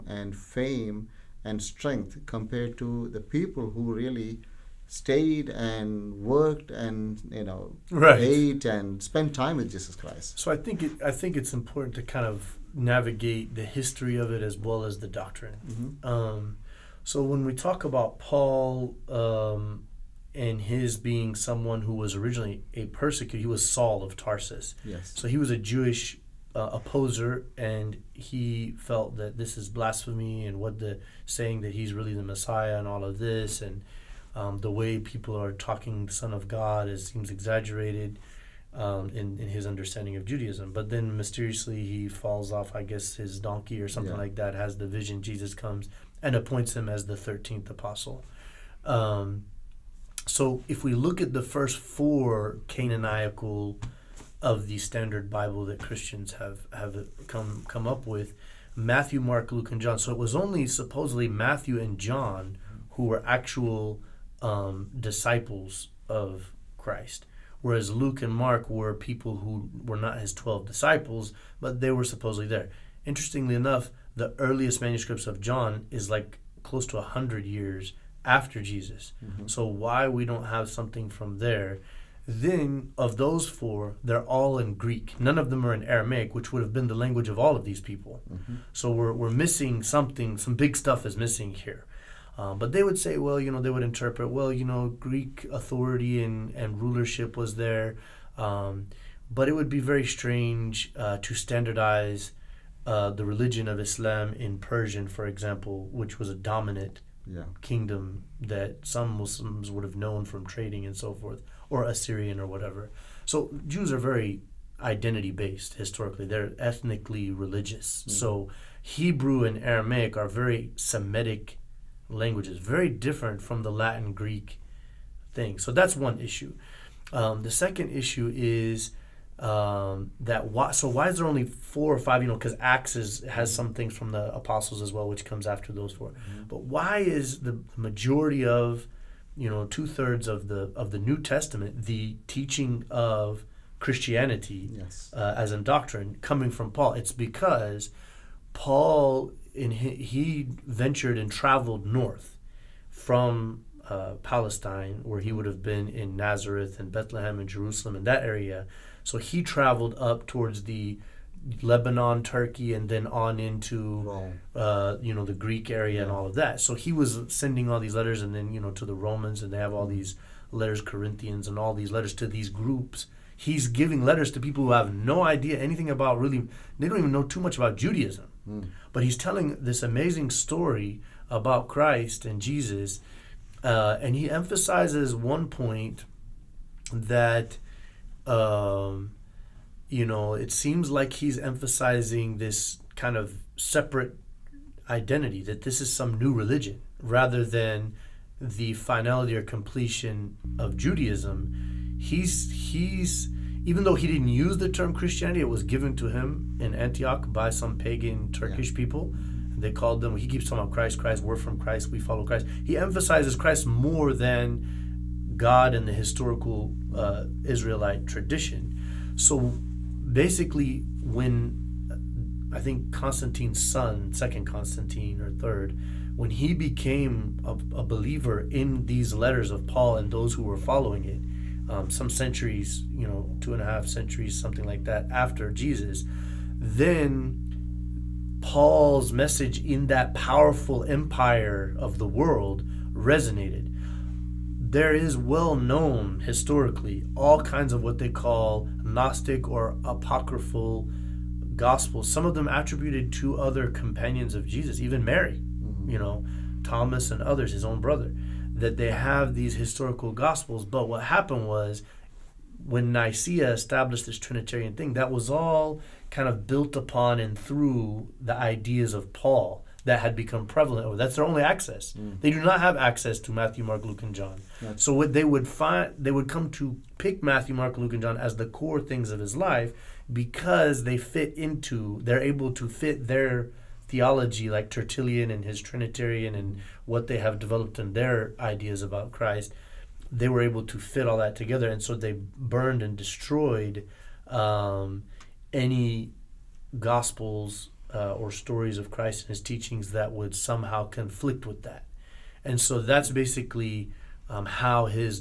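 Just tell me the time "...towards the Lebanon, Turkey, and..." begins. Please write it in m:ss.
2:40.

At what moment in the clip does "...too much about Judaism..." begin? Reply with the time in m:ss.
2:57.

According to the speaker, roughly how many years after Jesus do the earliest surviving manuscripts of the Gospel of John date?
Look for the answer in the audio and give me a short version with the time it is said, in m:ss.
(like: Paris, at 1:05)
close to 100 years, at 1:16.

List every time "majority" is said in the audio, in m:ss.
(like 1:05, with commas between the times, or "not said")
2:17.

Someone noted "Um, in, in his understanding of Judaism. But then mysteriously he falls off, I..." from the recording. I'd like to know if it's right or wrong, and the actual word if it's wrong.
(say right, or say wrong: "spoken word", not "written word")
right.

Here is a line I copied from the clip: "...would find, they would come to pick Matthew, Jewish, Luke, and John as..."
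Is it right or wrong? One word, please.
wrong.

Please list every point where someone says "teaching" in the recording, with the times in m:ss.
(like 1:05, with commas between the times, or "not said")
2:22, 4:59.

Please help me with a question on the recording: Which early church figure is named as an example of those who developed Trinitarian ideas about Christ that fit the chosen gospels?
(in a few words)
Tertullian.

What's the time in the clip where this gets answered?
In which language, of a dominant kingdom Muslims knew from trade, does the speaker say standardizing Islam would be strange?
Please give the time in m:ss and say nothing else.
1:44.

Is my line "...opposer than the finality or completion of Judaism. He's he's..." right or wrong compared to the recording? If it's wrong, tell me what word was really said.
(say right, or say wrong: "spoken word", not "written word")
wrong: "rather", not "opposer".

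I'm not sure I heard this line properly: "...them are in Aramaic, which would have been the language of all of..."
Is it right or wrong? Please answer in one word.
right.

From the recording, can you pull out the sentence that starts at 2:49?
these letters, Corinthians, and all these letters to these groups.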